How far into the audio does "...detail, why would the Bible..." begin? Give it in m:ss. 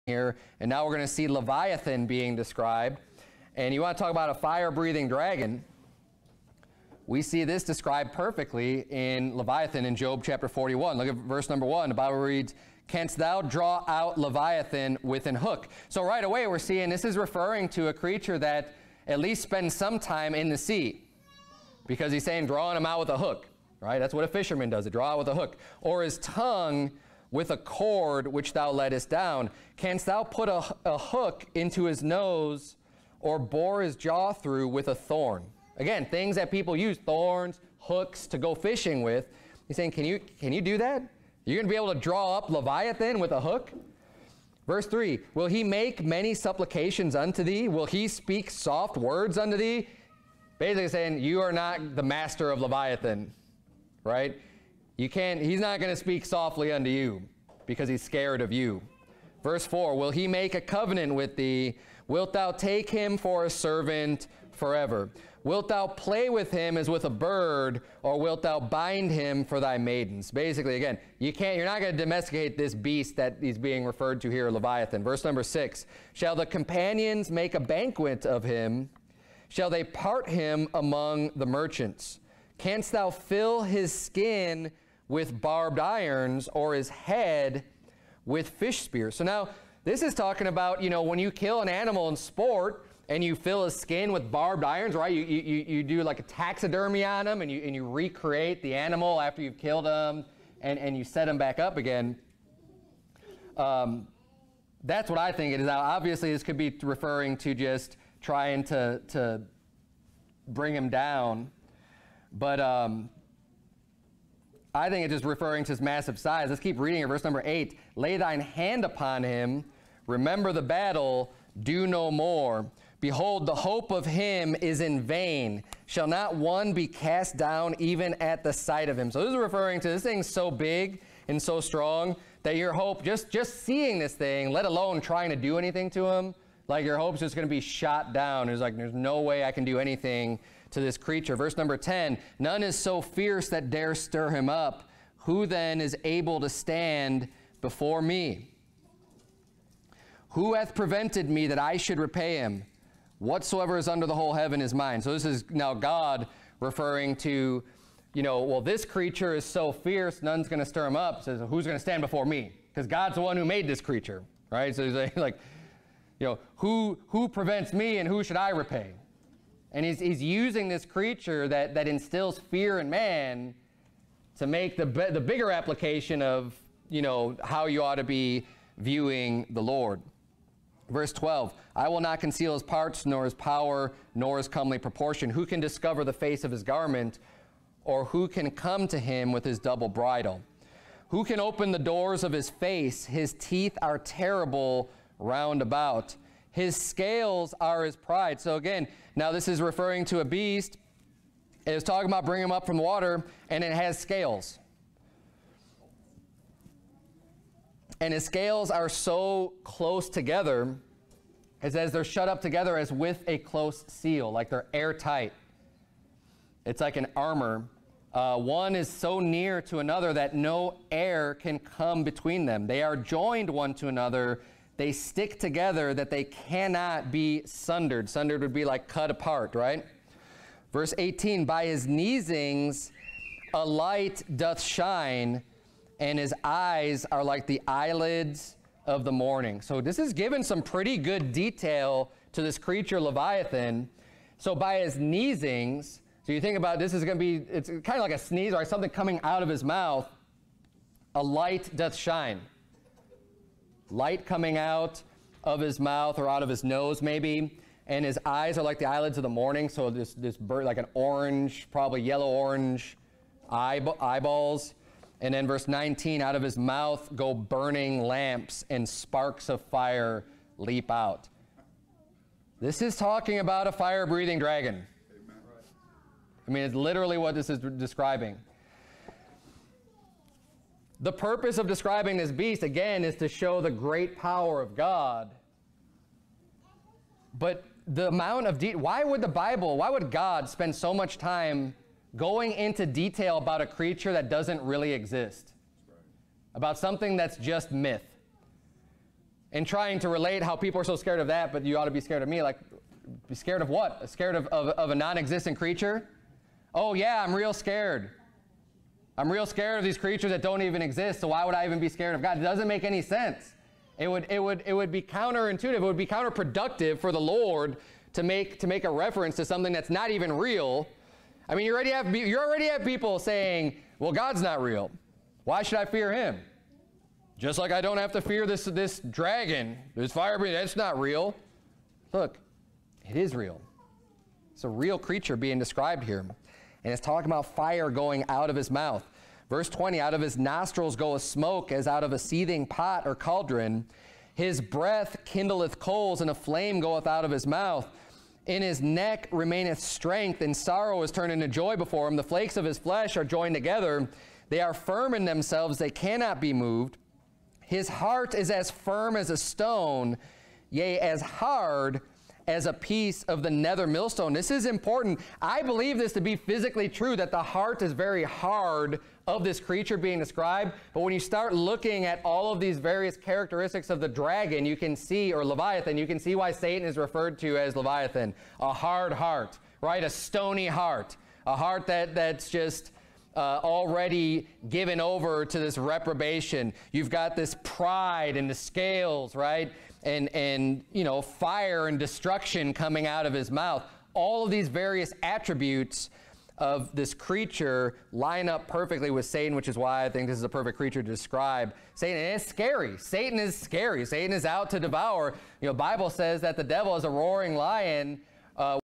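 4:48.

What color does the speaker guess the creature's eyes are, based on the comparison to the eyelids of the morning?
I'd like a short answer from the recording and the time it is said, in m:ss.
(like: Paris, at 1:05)
yellow orange, at 4:22.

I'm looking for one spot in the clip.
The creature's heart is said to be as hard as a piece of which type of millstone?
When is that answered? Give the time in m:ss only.
6:03.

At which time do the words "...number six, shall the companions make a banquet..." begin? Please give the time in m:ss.
1:15.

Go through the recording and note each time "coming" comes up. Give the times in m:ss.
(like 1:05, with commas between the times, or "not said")
4:08, 4:14, 6:32.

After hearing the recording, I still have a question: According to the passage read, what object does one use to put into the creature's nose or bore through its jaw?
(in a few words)
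a thorn.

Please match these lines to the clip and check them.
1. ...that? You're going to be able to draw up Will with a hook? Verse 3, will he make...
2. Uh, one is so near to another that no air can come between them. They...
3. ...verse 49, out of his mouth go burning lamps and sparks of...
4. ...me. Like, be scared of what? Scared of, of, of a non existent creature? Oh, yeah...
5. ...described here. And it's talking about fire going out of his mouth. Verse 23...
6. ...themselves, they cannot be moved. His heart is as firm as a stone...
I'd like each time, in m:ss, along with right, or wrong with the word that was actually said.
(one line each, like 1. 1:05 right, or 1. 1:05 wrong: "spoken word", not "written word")
1. 0:40 wrong: "Leviathan", not "Will"
2. 3:38 right
3. 4:25 wrong: "19", not "49"
4. 5:02 right
5. 5:35 wrong: "20", not "23"
6. 5:55 right.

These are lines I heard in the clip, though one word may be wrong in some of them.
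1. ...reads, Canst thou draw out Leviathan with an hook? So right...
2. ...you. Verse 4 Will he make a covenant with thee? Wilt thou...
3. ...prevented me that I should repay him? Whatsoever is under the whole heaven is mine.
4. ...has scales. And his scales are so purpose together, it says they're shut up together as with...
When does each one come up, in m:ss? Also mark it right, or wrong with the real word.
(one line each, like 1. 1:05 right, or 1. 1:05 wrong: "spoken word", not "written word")
1. 0:12 right
2. 0:58 right
3. 2:30 right
4. 3:23 wrong: "close", not "purpose".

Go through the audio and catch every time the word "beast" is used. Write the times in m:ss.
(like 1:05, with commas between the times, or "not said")
1:12, 3:20, 4:42.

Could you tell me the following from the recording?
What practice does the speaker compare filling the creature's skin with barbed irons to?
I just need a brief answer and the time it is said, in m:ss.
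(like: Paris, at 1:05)
taxidermy, at 1:36.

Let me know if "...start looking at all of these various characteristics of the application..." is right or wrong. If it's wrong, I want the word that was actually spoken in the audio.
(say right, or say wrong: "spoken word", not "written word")
wrong: "dragon", not "application".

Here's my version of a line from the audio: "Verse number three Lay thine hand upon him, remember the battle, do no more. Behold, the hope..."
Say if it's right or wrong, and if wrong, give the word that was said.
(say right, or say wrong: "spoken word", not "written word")
wrong: "eight", not "three".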